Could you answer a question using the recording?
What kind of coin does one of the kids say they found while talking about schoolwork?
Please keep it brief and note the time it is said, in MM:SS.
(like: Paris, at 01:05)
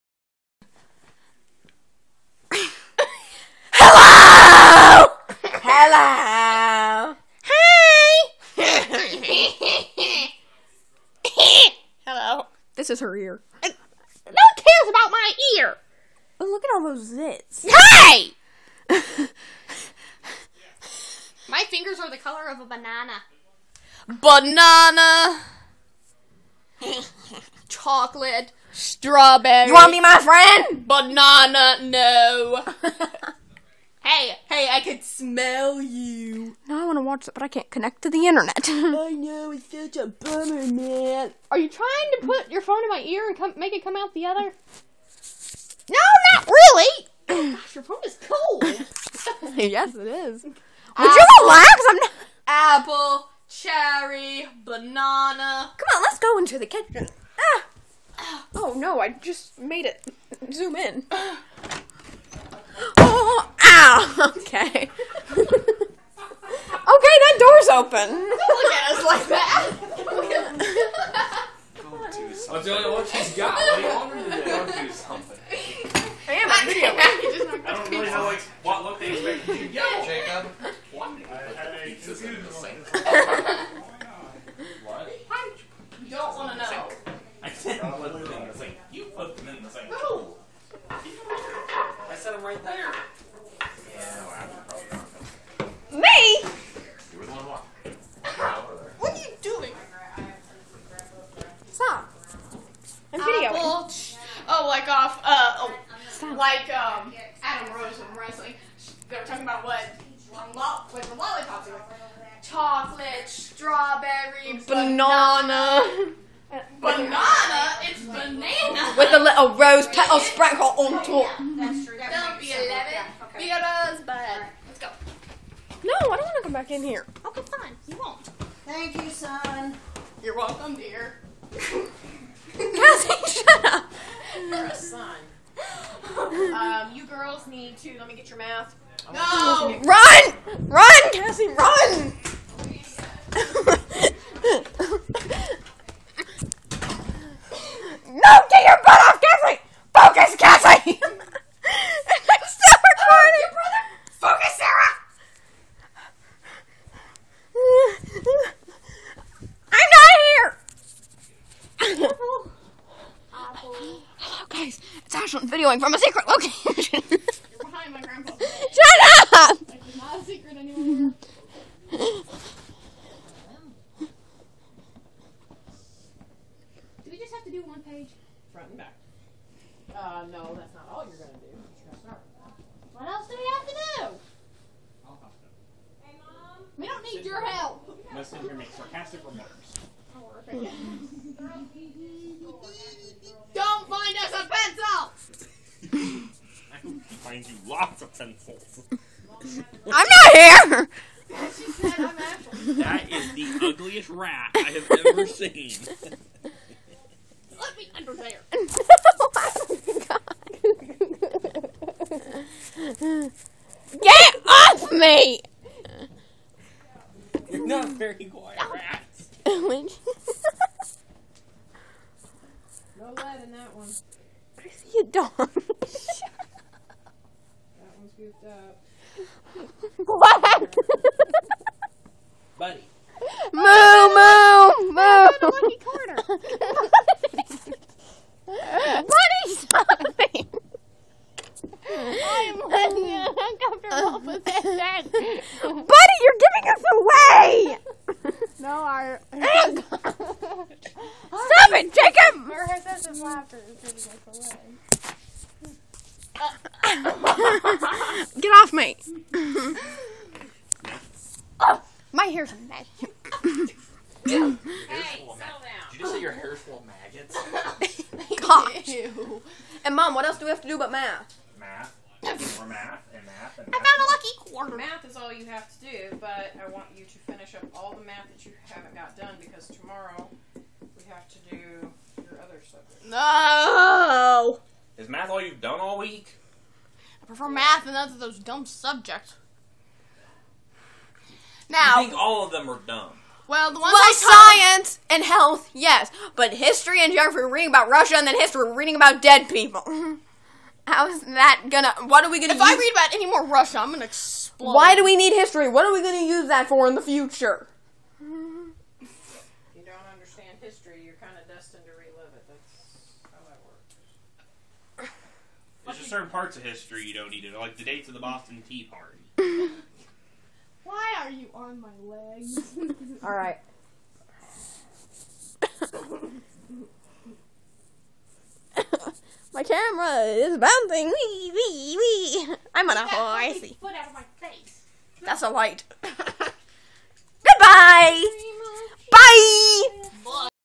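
lucky quarter, at 04:34.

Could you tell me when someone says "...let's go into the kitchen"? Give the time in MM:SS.
00:56.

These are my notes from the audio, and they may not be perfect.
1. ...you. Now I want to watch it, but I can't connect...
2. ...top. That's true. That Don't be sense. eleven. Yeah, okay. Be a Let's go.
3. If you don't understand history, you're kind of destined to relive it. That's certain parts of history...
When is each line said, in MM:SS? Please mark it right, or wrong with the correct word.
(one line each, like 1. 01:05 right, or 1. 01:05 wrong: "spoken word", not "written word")
1. 00:35 right
2. 02:01 right
3. 05:08 right.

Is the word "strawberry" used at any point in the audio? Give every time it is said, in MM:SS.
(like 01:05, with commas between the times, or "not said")
00:28, 01:53.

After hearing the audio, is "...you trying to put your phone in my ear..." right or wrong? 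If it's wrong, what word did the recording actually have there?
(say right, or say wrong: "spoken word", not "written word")
right.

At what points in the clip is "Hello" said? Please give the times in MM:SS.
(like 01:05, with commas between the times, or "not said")
00:05, 00:12.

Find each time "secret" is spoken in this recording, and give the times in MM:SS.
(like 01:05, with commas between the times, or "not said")
02:45, 02:50.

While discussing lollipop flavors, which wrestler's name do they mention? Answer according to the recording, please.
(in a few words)
Adam Rose.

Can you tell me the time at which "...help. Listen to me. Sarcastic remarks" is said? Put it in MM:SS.
03:07.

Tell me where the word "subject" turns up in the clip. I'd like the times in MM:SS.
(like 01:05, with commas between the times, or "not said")
04:42, 04:48.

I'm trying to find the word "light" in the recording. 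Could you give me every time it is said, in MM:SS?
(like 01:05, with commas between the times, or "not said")
05:35.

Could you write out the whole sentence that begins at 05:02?
I read about any more Russia, I'm gonna explode.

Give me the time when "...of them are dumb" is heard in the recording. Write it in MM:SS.
04:52.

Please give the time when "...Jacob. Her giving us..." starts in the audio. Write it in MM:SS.
04:11.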